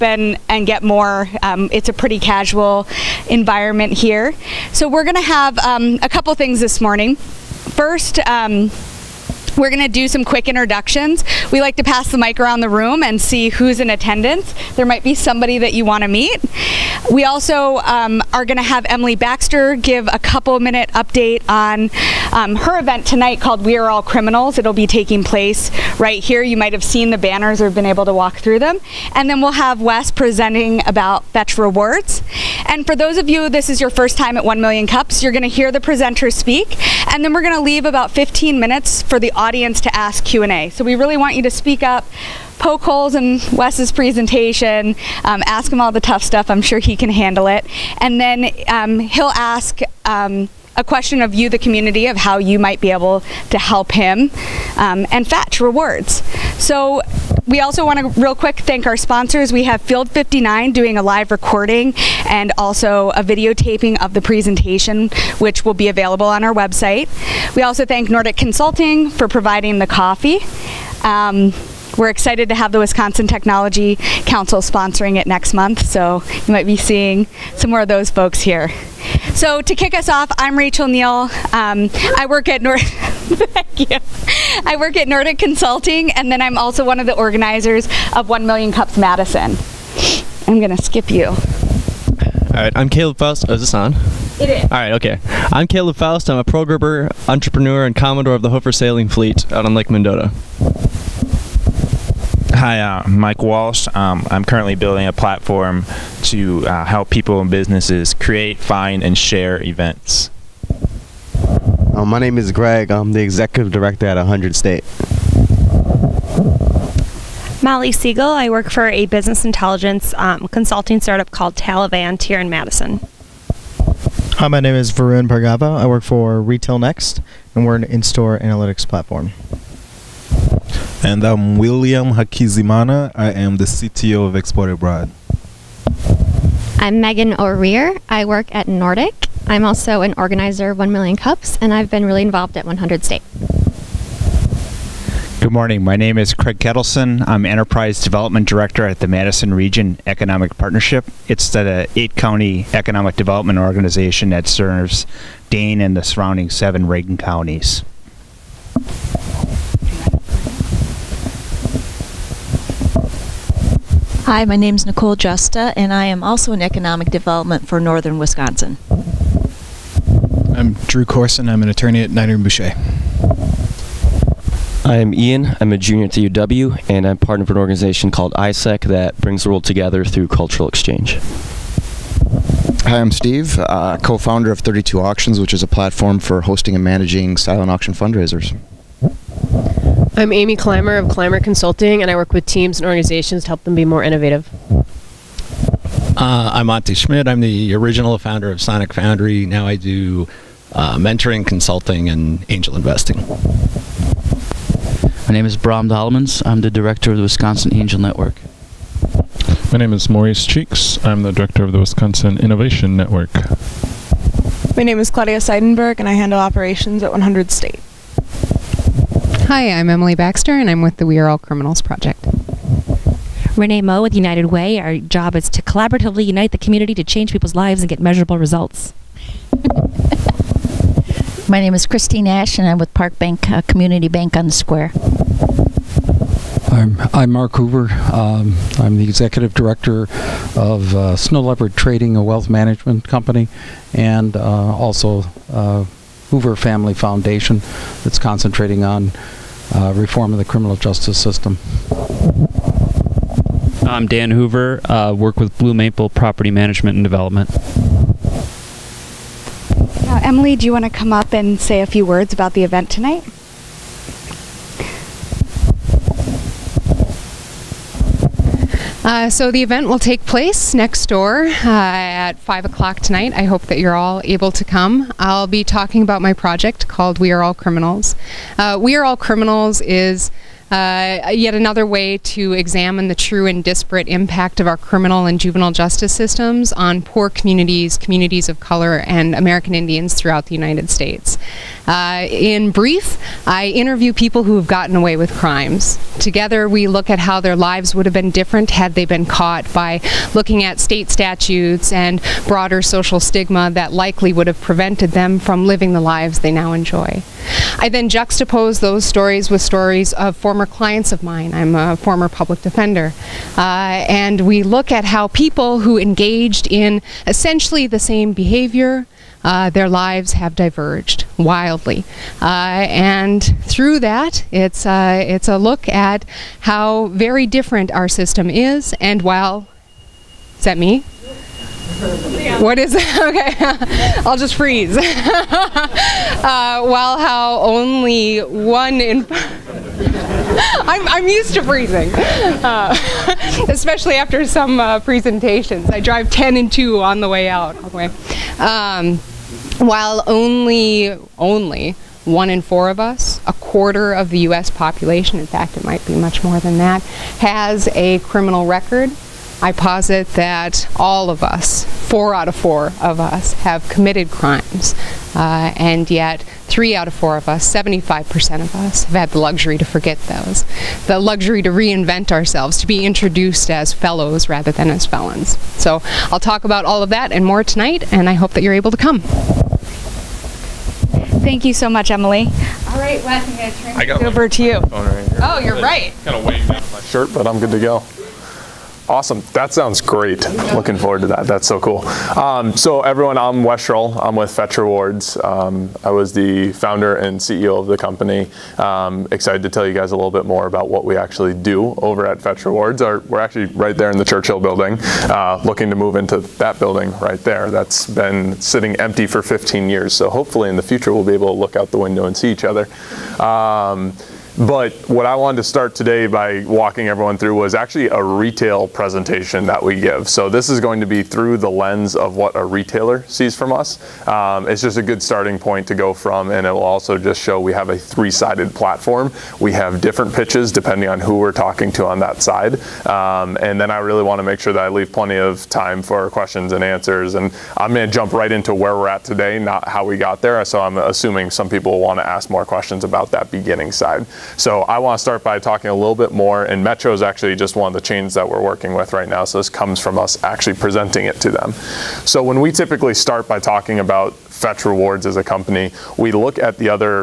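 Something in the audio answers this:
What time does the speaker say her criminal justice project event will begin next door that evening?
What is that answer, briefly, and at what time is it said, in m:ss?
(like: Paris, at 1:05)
5 o'clock, at 4:32.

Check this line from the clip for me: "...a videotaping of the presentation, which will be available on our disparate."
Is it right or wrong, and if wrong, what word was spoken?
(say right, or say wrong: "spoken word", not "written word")
wrong: "website", not "disparate".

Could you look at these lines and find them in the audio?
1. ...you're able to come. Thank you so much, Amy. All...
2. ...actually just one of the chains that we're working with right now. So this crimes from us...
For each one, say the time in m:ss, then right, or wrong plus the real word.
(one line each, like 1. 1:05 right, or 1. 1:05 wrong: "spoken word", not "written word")
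1. 6:18 wrong: "Emily", not "Amy"
2. 7:27 wrong: "comes", not "crimes".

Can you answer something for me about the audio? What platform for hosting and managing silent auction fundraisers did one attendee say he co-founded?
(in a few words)
32 Auctions.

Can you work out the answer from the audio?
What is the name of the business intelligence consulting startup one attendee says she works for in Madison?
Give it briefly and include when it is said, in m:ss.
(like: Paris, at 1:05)
Talavant, at 2:01.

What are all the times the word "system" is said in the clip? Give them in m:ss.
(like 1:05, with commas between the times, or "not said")
4:11, 4:46, 5:28.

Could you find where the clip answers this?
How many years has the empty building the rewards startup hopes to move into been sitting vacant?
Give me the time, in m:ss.
6:49.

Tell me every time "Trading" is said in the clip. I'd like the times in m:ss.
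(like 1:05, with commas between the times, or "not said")
4:01.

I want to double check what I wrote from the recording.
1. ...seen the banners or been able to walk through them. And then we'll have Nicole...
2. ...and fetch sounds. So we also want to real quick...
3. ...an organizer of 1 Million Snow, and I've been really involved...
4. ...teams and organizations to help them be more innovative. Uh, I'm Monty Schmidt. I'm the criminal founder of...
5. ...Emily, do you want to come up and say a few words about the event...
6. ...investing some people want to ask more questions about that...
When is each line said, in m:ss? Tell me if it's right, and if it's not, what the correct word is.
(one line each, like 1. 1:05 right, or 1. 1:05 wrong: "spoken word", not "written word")
1. 0:26 wrong: "Wes", not "Nicole"
2. 0:55 wrong: "rewards", not "sounds"
3. 2:20 wrong: "Cups", not "Snow"
4. 3:12 wrong: "original", not "criminal"
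5. 4:20 right
6. 7:20 wrong: "assuming", not "investing".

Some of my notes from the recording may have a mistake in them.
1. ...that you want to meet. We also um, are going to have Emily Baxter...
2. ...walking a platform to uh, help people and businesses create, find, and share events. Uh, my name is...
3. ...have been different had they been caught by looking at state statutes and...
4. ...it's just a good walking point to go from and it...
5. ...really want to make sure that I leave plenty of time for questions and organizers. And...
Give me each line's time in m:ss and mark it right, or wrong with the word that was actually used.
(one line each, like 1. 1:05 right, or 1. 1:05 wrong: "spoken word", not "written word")
1. 0:15 right
2. 1:44 wrong: "building", not "walking"
3. 4:58 right
4. 7:04 wrong: "starting", not "walking"
5. 7:13 wrong: "answers", not "organizers".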